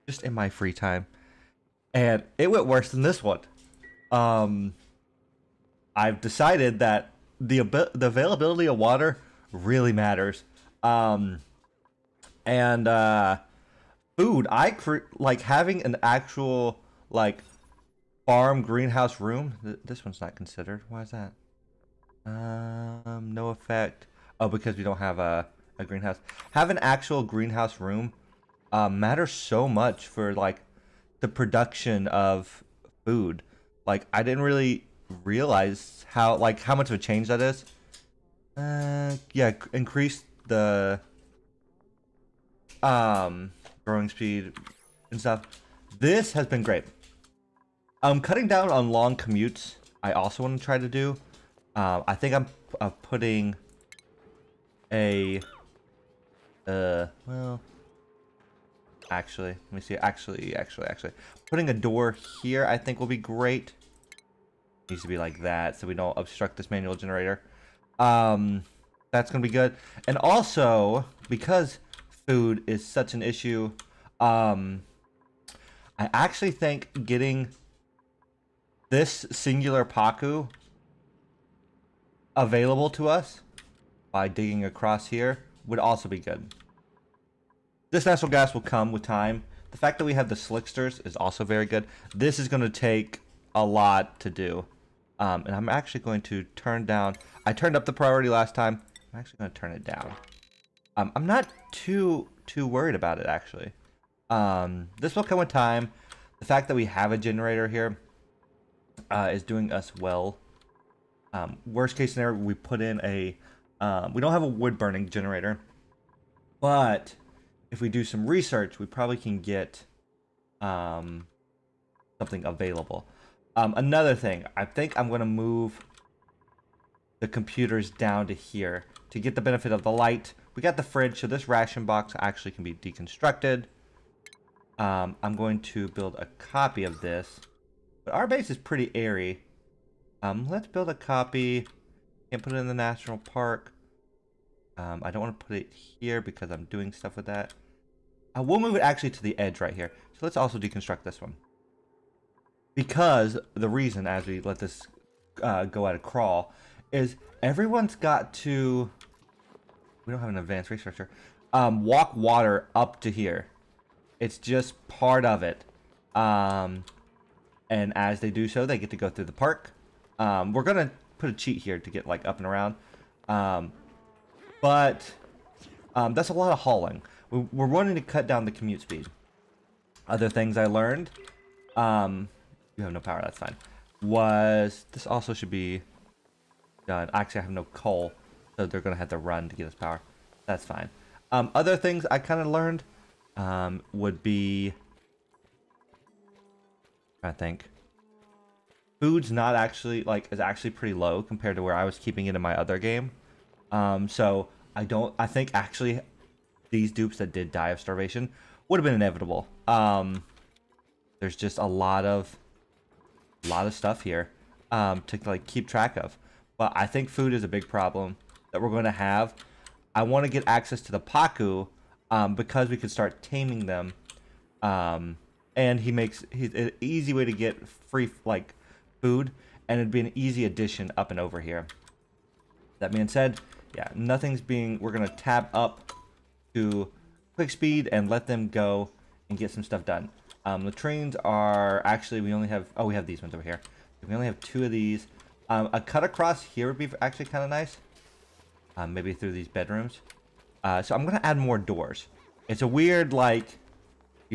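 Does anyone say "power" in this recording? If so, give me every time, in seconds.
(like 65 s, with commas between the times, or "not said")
182 s, 189 s.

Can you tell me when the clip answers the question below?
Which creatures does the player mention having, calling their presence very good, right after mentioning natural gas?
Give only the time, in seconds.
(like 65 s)
90 s.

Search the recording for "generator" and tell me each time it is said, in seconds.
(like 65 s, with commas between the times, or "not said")
66 s, 107 s, 115 s.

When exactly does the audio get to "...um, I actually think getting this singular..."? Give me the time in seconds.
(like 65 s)
74 s.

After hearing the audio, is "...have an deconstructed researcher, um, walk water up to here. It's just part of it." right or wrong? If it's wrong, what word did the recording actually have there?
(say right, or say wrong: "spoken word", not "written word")
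wrong: "advanced", not "deconstructed".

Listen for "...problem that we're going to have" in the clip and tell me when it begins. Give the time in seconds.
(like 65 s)
217 s.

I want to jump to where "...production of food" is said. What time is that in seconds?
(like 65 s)
31 s.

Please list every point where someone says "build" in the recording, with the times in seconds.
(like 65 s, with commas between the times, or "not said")
135 s, 140 s.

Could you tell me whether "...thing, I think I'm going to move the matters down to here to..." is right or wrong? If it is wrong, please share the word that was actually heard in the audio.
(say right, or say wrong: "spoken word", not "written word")
wrong: "computers", not "matters".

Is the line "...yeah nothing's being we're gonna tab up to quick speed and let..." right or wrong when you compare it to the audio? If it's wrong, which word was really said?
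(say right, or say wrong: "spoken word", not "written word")
right.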